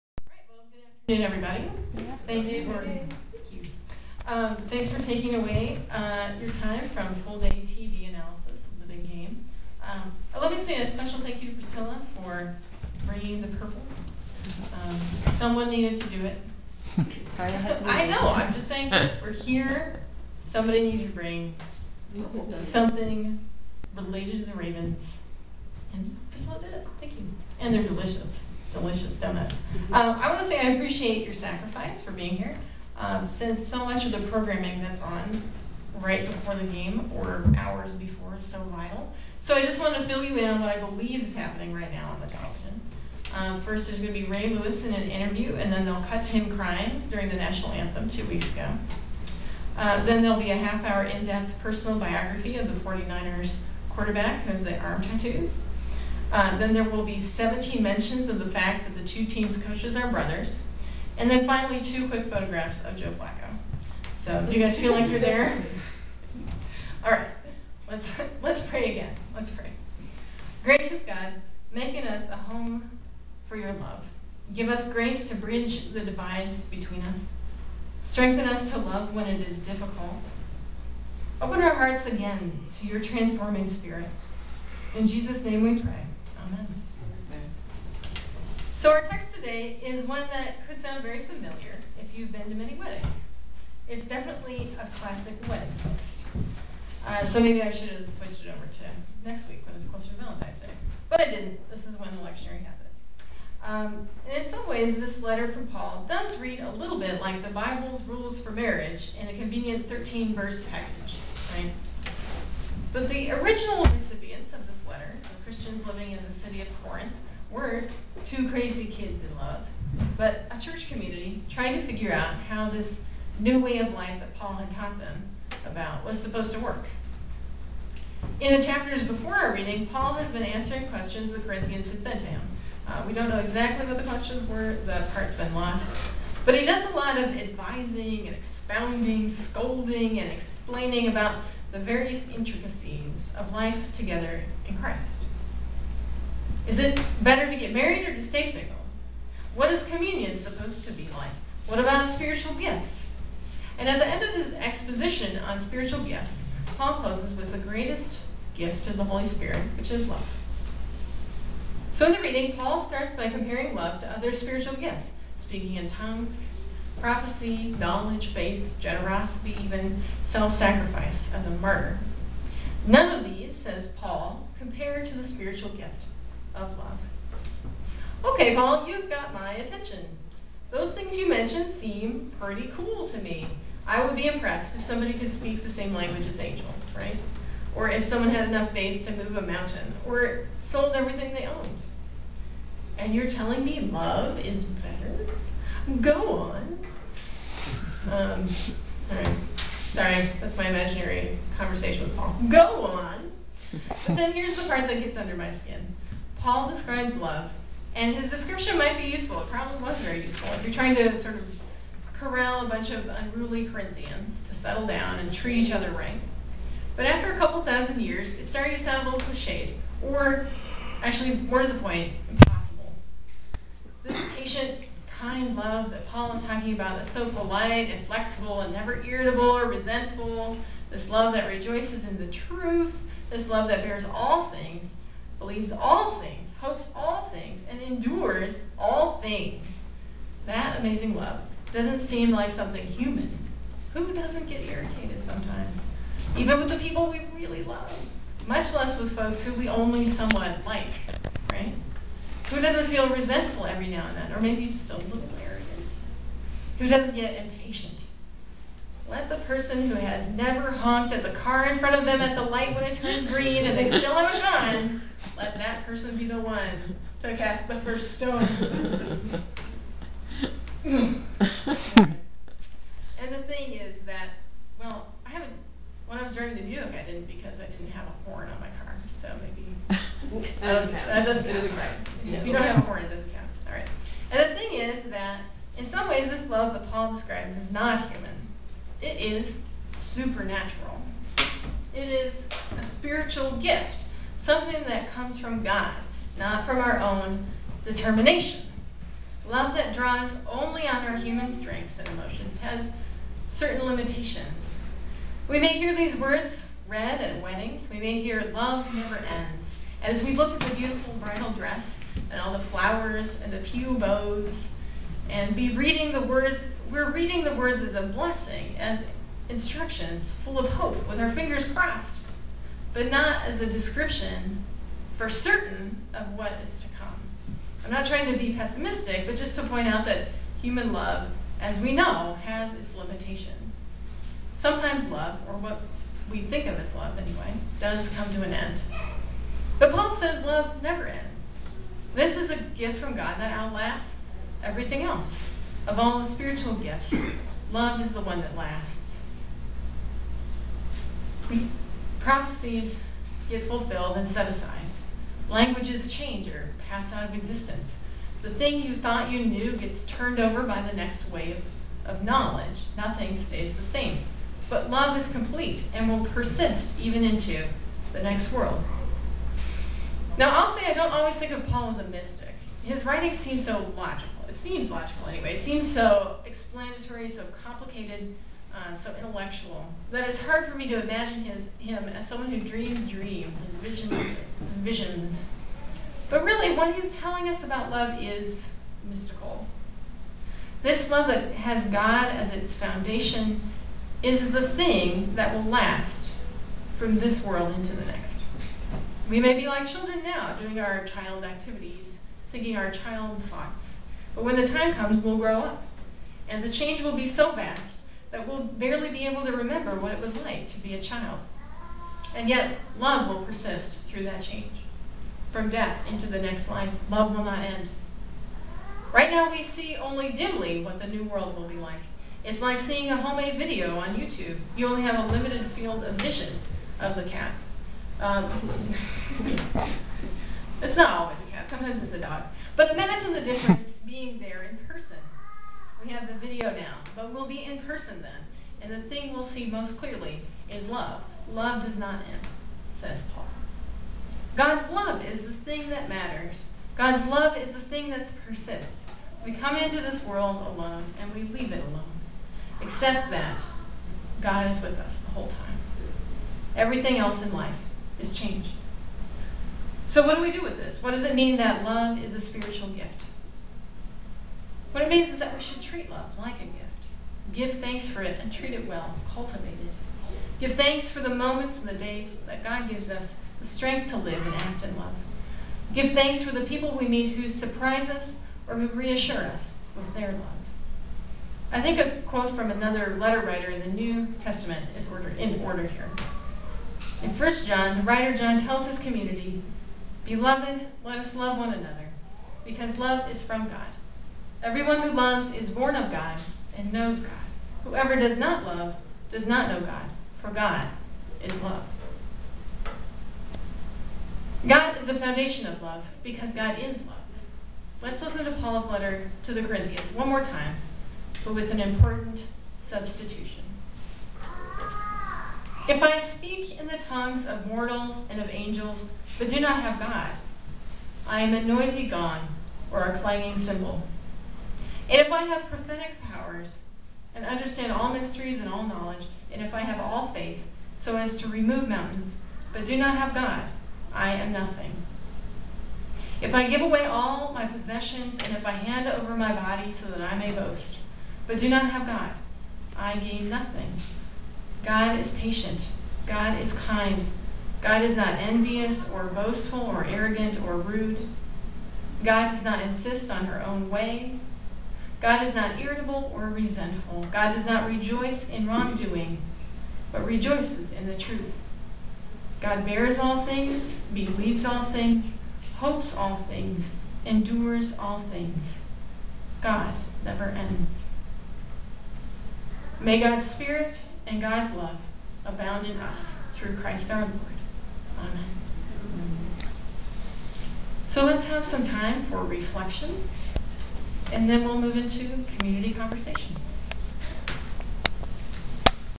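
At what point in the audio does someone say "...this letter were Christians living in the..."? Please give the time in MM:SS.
01:54.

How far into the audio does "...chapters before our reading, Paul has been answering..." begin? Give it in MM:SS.
02:08.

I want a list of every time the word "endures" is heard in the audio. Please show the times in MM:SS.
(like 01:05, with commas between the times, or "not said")
03:57, 09:27.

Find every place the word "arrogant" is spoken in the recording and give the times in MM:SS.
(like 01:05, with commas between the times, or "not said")
04:15, 09:10.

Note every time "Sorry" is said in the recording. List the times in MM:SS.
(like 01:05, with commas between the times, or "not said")
00:17, 03:19.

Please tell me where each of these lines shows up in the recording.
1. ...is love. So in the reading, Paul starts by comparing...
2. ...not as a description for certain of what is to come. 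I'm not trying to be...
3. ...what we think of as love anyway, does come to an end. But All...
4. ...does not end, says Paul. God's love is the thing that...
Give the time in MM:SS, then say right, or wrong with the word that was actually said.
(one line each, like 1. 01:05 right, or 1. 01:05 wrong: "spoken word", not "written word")
1. 02:39 right
2. 05:23 right
3. 05:35 wrong: "Paul", not "All"
4. 07:21 right.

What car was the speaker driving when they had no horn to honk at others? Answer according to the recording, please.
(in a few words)
Buick.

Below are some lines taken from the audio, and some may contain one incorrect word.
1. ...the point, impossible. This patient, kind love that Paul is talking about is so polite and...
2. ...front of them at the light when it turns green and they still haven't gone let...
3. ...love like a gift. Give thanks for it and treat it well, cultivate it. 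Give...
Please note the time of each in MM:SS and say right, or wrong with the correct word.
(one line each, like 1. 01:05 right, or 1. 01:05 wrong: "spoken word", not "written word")
1. 03:41 right
2. 04:21 right
3. 07:46 right.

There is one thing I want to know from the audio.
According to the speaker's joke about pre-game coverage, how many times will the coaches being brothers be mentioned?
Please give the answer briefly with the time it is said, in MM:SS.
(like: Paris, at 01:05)
17, at 00:57.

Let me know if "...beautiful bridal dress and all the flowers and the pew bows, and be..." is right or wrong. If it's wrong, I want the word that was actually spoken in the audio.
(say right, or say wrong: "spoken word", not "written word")
right.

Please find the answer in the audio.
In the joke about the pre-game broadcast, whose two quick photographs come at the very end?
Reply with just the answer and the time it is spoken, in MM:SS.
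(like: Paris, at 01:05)
Joe Flacco, at 01:02.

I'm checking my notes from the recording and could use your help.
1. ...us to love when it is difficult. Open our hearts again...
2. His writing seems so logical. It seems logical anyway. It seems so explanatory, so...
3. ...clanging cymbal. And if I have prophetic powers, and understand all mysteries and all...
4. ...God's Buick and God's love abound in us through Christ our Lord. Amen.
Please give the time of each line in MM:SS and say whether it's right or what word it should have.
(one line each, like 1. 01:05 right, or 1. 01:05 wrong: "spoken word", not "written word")
1. 01:18 right
2. 06:12 right
3. 08:43 right
4. 09:33 wrong: "Spirit", not "Buick".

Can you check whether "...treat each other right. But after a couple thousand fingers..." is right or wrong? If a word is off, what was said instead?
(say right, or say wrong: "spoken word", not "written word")
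wrong: "years", not "fingers".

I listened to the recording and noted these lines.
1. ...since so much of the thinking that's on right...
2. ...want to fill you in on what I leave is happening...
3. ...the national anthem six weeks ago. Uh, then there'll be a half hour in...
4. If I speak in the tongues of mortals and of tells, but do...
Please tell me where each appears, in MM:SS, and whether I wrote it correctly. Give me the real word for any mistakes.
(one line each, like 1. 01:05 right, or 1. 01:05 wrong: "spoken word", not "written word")
1. 00:33 wrong: "programming", not "thinking"
2. 00:39 wrong: "believe", not "leave"
3. 00:47 wrong: "two", not "six"
4. 08:35 wrong: "angels", not "tells".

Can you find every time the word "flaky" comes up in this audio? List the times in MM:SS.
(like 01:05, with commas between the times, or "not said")
not said.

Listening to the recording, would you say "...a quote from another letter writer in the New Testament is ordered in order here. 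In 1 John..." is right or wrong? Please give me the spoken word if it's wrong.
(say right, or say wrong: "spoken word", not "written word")
right.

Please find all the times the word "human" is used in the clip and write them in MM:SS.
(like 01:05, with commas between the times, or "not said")
04:02, 04:48, 05:01, 05:30.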